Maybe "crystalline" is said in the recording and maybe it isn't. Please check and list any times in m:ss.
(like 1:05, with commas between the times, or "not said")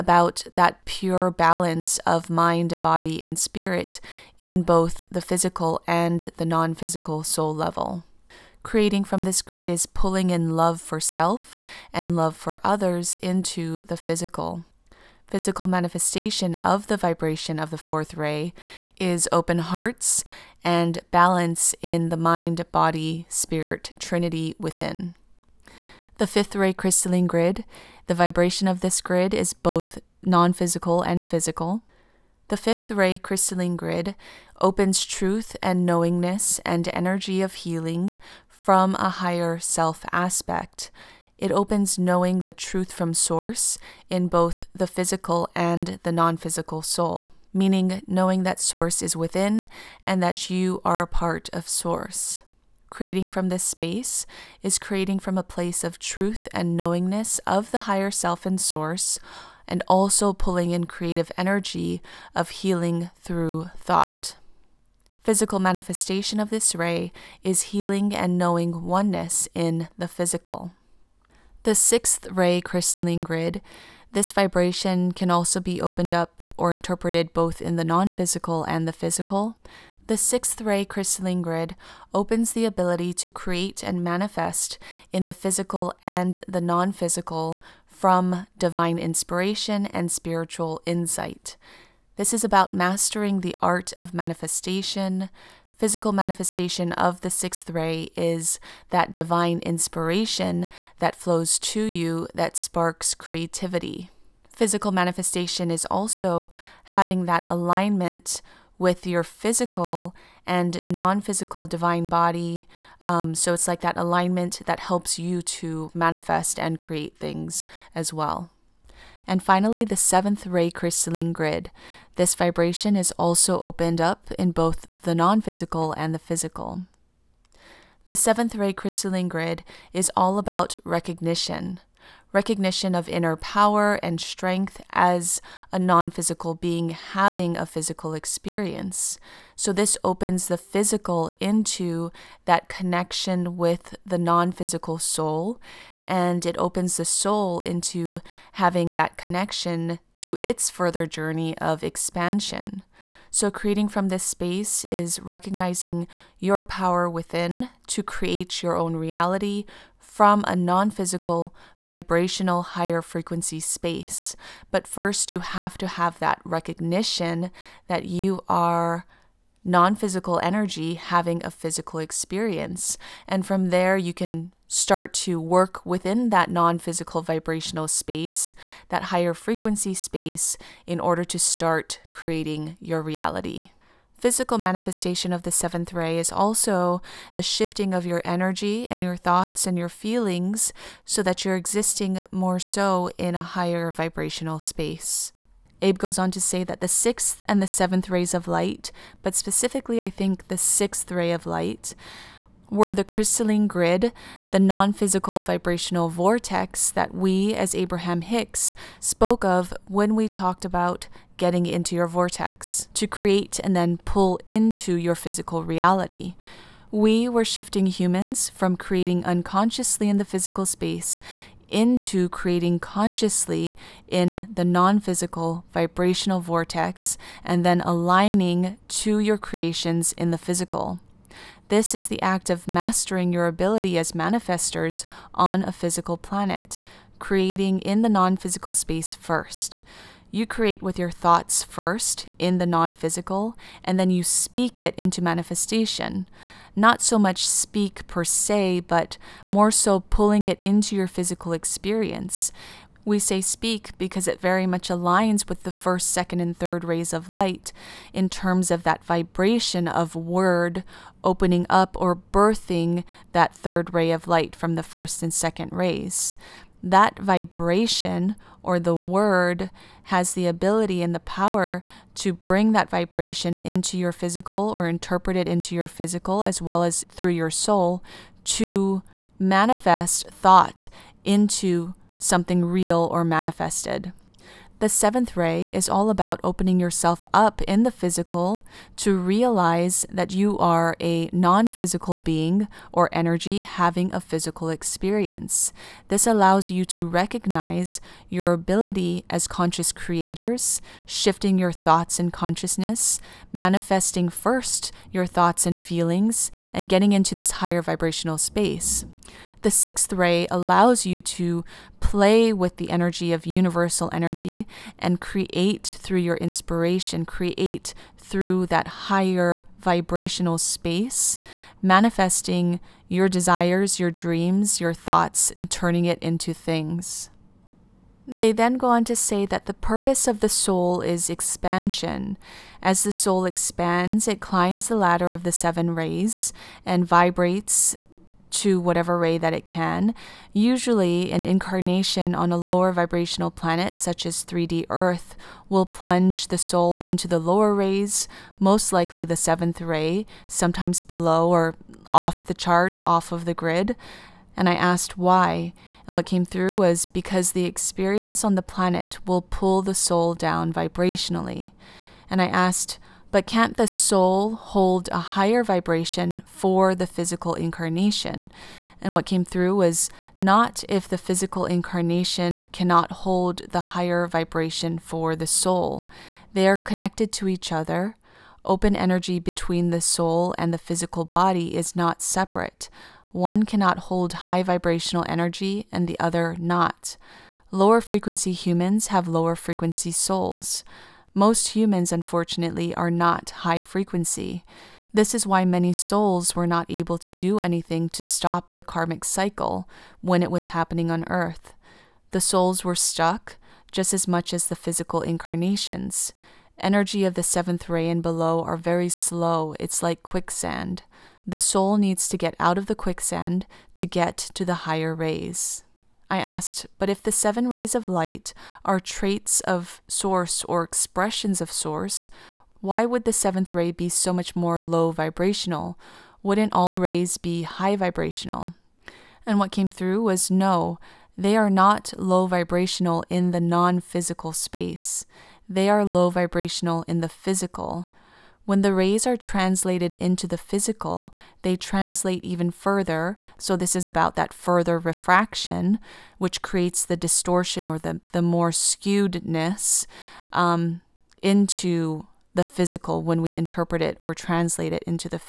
0:26, 0:33, 1:12, 1:20, 2:00, 2:08, 3:23.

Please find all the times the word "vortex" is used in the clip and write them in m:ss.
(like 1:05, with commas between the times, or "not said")
3:26, 3:32, 3:46.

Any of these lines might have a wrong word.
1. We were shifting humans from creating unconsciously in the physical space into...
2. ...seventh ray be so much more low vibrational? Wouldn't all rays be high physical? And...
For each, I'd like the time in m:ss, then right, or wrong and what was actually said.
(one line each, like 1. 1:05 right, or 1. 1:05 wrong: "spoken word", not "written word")
1. 3:36 right
2. 7:03 wrong: "vibrational", not "physical".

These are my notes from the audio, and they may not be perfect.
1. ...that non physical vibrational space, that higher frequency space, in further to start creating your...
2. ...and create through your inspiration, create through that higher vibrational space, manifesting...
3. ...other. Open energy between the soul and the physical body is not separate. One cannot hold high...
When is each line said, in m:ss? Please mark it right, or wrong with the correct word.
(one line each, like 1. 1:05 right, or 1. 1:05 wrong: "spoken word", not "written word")
1. 2:56 wrong: "order", not "further"
2. 5:14 right
3. 6:17 right.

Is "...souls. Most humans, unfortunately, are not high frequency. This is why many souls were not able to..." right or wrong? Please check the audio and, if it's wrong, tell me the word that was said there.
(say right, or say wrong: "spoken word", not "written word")
right.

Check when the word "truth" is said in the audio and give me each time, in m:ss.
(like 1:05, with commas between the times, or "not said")
0:35, 0:42, 0:55.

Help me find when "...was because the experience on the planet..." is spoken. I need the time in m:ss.
5:56.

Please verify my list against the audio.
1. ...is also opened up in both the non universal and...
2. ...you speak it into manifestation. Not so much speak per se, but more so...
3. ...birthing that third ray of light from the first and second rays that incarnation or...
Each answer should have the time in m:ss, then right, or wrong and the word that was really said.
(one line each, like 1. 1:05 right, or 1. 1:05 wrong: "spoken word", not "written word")
1. 2:02 wrong: "physical", not "universal"
2. 4:04 right
3. 4:22 wrong: "vibration", not "incarnation".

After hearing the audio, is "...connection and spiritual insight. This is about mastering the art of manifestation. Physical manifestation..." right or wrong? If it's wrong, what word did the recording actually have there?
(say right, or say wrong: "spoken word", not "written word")
wrong: "inspiration", not "connection".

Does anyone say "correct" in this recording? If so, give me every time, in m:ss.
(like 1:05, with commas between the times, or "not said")
not said.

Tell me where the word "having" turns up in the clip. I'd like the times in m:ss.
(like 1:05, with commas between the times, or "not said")
1:46, 2:16, 2:28, 2:50, 4:53.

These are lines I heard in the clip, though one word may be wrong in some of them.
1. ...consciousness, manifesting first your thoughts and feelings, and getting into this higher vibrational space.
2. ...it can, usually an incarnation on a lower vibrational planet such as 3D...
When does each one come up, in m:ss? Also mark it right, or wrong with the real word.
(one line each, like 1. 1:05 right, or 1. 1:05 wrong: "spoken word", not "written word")
1. 5:02 right
2. 5:39 right.